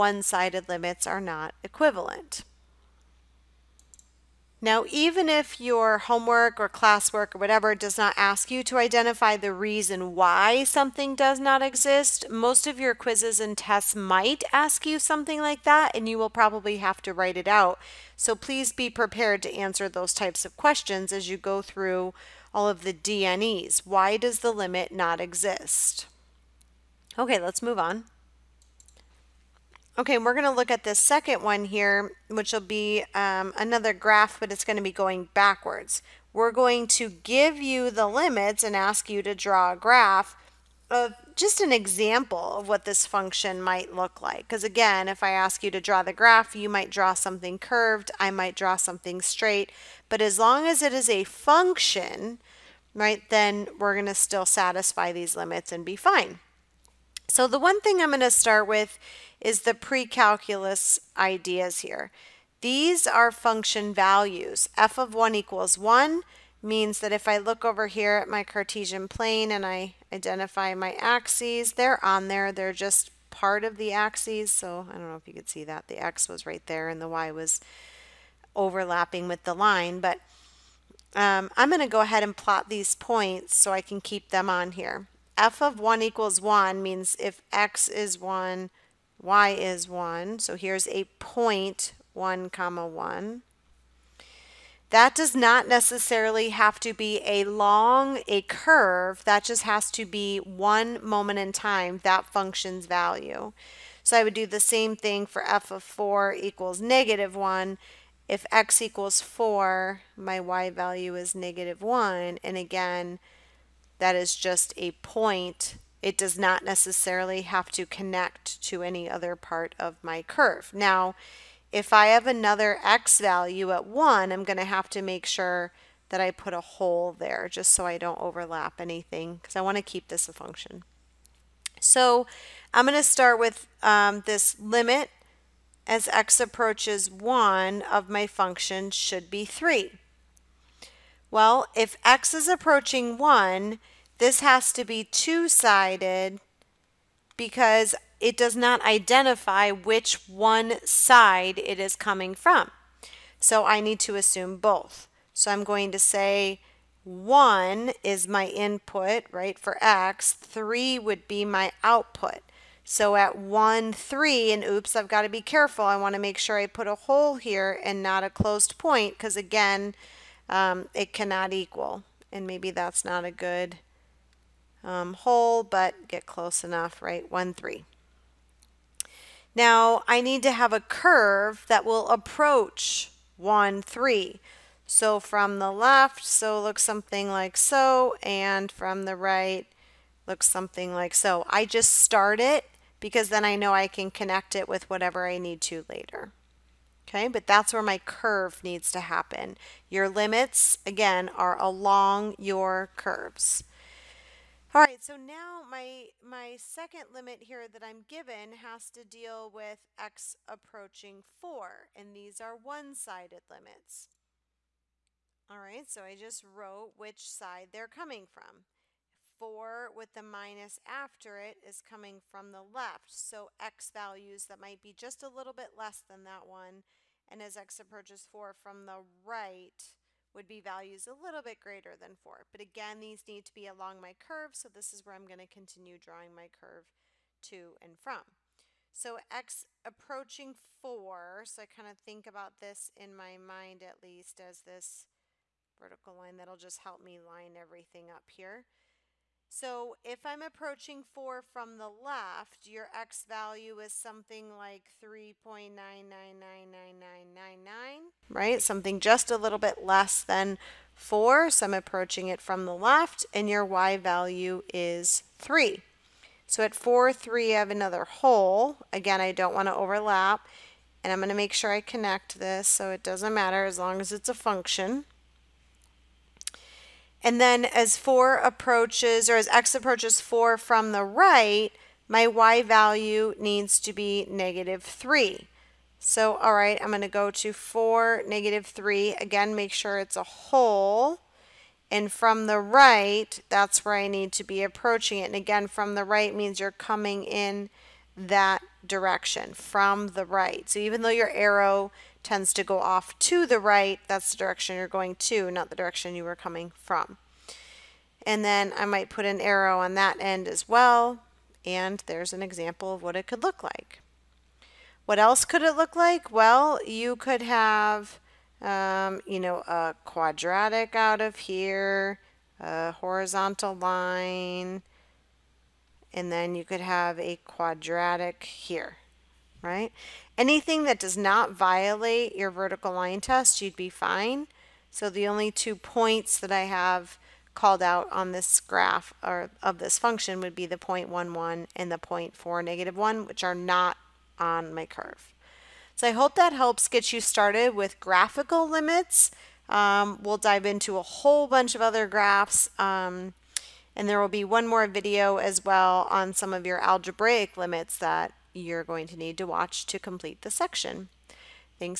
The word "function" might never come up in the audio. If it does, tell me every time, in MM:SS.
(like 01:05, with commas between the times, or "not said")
00:43, 00:51, 01:03, 01:42, 02:10, 02:18, 04:34, 05:39.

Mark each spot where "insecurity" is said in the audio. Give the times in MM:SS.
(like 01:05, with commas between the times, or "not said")
not said.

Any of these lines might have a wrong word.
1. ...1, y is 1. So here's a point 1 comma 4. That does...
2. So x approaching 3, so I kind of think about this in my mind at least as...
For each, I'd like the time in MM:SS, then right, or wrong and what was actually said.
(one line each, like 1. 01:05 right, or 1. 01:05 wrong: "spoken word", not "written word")
1. 01:28 wrong: "1", not "4"
2. 03:58 wrong: "4", not "3".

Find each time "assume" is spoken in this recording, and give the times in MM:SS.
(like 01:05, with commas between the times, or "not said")
02:34.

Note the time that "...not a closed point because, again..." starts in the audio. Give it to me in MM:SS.
02:48.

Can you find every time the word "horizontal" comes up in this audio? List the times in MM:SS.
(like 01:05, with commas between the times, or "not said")
05:22.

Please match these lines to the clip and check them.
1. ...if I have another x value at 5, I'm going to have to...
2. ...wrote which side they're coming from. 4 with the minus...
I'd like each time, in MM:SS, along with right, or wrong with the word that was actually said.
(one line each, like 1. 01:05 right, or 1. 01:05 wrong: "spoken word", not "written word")
1. 02:01 wrong: "1", not "5"
2. 03:36 right.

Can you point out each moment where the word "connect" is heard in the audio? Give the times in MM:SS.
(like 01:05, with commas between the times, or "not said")
01:57, 03:14, 04:31.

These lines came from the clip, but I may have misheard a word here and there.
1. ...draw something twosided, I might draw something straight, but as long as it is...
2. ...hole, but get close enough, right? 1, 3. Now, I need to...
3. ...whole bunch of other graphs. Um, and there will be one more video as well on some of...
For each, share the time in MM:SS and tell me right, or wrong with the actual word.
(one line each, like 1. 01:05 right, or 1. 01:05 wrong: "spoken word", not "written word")
1. 00:46 wrong: "curved", not "twosided"
2. 02:55 right
3. 05:51 right.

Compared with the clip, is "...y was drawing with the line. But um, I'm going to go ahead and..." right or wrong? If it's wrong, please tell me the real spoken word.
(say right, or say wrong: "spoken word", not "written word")
wrong: "overlapping", not "drawing".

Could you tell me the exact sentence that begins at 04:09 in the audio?
So if I'm approaching 4 from the left, your x value is something like 3.999999, right?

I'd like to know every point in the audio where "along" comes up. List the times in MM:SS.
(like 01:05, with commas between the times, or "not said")
03:21, 03:53.